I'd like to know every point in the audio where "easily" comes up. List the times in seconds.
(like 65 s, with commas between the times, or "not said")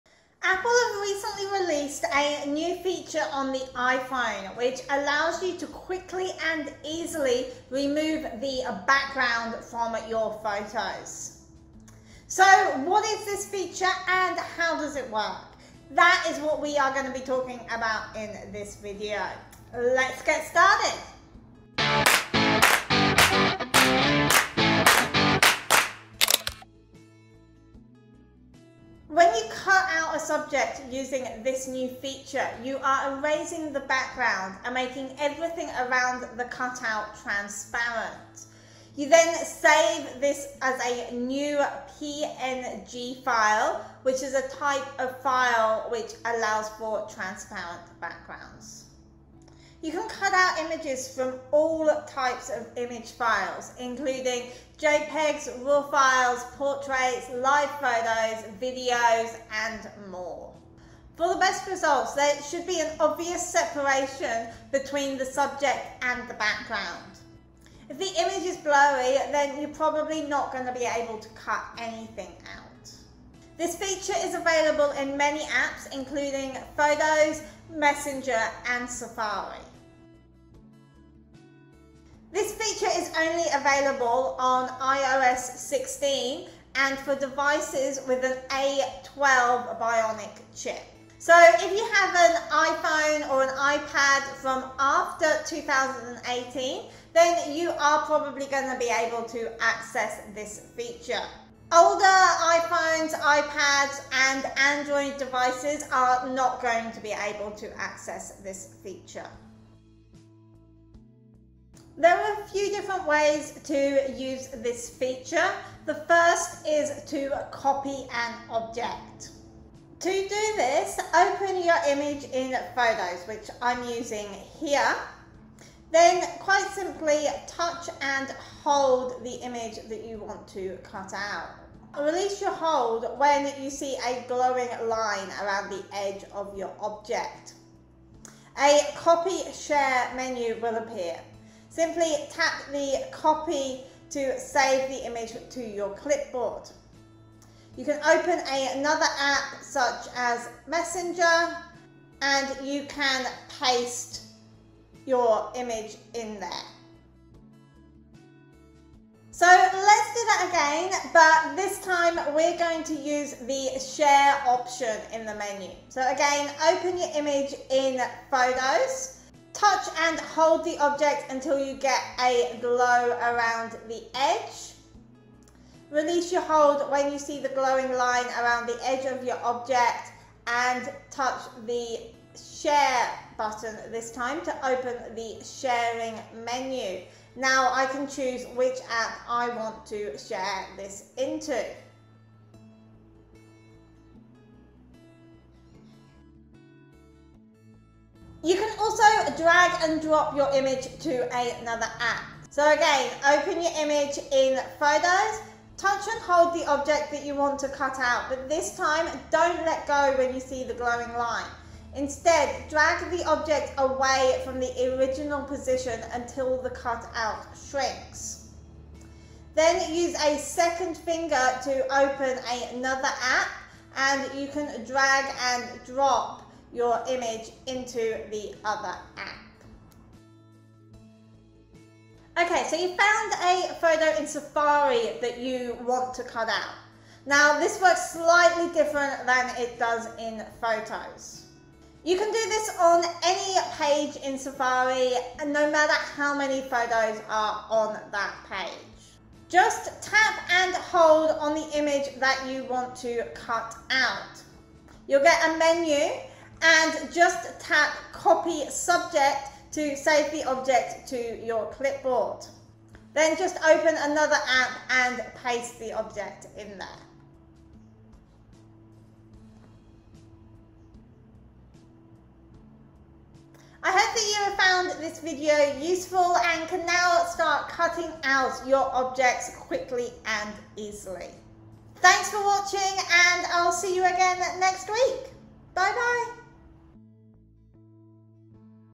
6 s, 280 s.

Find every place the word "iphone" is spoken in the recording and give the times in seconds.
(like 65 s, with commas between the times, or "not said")
3 s, 92 s, 102 s.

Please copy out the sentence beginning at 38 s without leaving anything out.
You then save this as a new PNG file, which is a type of file which allows for transparent backgrounds.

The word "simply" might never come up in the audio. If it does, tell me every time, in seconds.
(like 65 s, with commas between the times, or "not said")
126 s, 141 s.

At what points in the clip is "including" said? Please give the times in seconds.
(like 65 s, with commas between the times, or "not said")
53 s, 75 s.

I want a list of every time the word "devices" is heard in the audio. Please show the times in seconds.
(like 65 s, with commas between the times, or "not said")
87 s, 105 s.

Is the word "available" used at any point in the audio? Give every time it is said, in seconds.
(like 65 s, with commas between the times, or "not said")
74 s, 83 s.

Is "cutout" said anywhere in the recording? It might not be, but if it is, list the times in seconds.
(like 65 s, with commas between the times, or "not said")
36 s, 216 s.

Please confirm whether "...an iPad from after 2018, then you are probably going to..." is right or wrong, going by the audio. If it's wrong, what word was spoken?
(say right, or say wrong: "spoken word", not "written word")
right.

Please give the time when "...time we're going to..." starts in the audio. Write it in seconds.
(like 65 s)
161 s.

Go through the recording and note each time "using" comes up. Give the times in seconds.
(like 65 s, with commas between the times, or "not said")
30 s, 123 s.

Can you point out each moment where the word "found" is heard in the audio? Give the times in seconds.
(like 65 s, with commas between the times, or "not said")
232 s, 274 s.